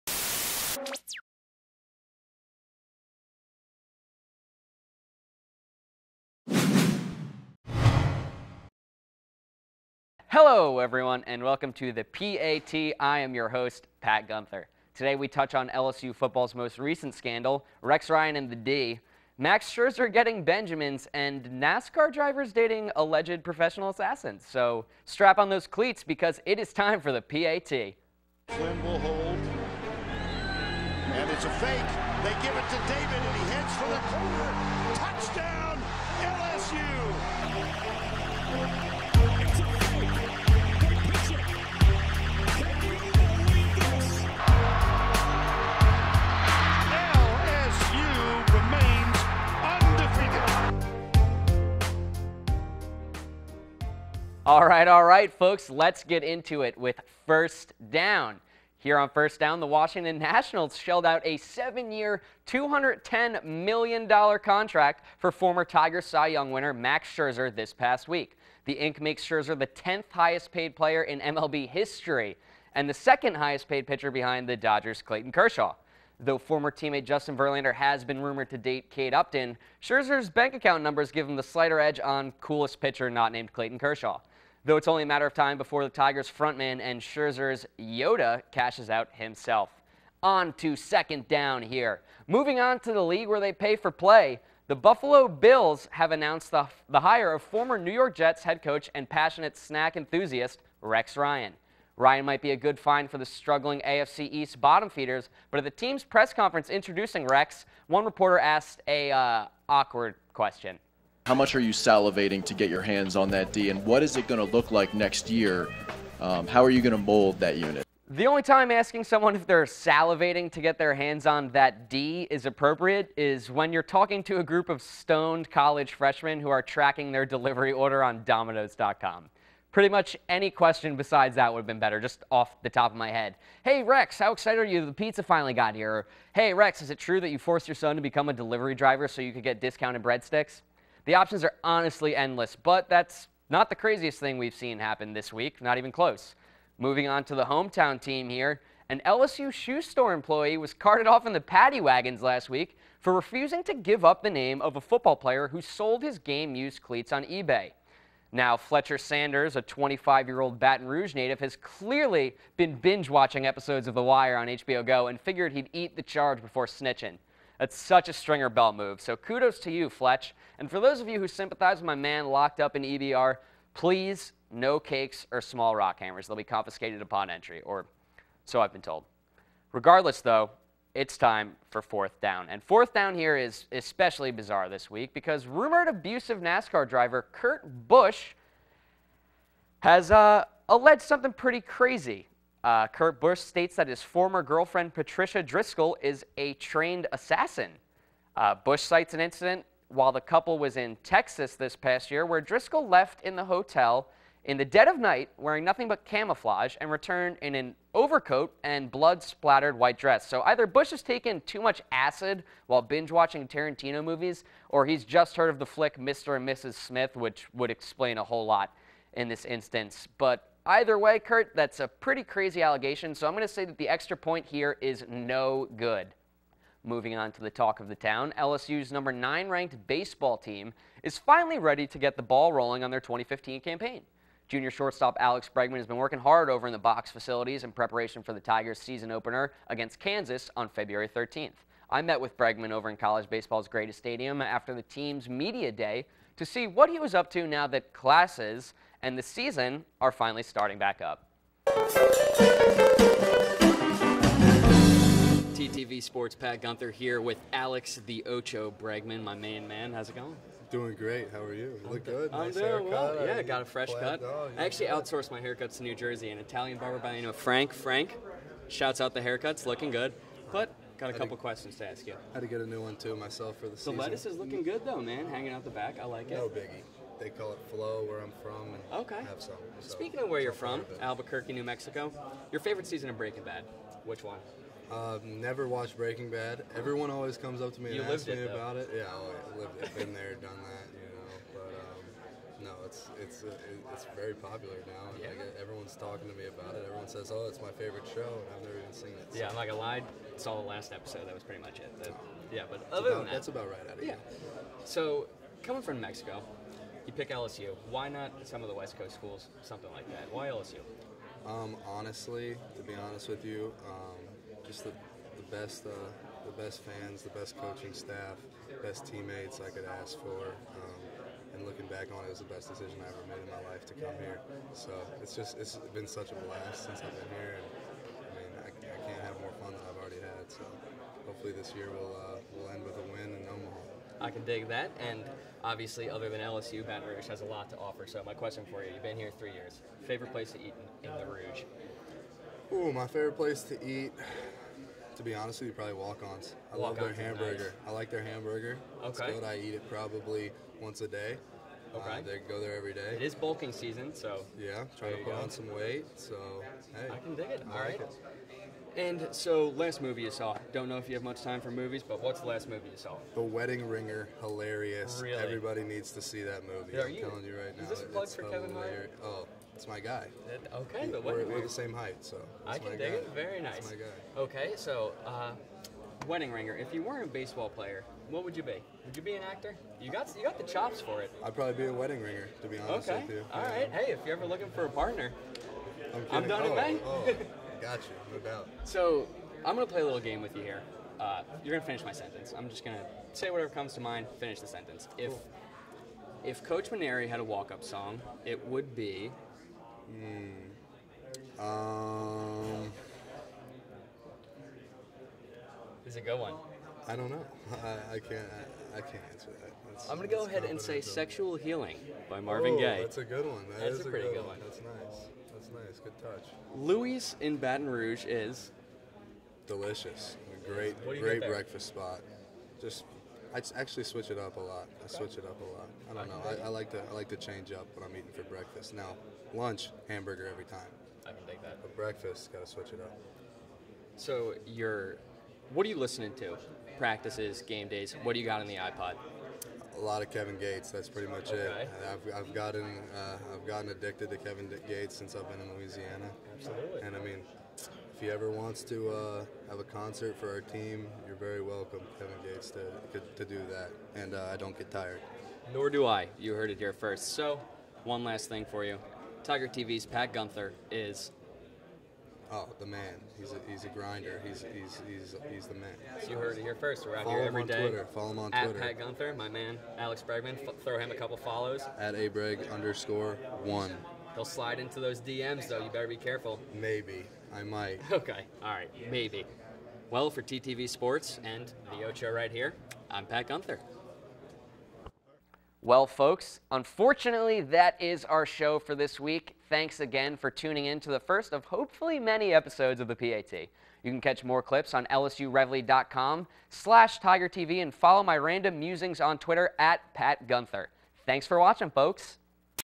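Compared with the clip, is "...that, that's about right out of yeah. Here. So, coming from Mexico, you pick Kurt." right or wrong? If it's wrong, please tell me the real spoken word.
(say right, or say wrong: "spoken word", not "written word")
wrong: "LSU", not "Kurt".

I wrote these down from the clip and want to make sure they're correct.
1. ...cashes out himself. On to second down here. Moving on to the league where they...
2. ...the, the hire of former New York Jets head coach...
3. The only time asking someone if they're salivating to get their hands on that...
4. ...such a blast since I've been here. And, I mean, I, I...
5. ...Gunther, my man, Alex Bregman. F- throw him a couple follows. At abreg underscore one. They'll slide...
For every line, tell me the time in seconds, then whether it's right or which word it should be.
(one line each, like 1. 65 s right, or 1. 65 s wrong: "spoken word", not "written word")
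1. 88 s right
2. 96 s right
3. 118 s right
4. 326 s right
5. 468 s right.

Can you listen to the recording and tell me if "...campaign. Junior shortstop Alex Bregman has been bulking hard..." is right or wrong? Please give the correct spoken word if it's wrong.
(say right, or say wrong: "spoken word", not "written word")
wrong: "working", not "bulking".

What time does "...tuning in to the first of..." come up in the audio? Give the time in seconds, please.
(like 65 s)
490 s.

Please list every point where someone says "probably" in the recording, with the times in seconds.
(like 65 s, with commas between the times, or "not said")
345 s, 349 s, 381 s.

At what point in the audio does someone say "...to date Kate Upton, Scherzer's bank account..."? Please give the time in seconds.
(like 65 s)
78 s.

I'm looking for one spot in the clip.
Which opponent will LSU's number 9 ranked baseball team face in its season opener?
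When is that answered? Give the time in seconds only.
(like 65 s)
239 s.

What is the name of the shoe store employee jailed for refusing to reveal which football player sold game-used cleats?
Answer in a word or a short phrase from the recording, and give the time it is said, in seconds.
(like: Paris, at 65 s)
Fletcher Sanders, at 158 s.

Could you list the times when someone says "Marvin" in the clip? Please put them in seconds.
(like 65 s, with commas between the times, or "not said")
412 s.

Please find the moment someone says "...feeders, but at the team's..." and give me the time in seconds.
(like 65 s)
104 s.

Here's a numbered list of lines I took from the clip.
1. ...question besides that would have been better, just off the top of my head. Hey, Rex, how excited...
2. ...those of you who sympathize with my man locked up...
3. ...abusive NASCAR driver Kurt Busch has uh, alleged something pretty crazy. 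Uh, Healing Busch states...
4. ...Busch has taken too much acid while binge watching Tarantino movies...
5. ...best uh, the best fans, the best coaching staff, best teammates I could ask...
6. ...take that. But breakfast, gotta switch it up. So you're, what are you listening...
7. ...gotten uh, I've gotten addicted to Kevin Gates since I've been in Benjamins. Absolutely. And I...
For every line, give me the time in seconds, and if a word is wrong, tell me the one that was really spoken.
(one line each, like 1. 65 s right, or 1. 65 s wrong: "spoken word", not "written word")
1. 130 s right
2. 170 s right
3. 185 s wrong: "Kurt", not "Healing"
4. 210 s right
5. 315 s right
6. 431 s right
7. 442 s wrong: "Louisiana", not "Benjamins".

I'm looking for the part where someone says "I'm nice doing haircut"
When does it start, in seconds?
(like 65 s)
262 s.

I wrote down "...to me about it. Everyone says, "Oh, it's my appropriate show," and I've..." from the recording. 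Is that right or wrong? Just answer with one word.
wrong.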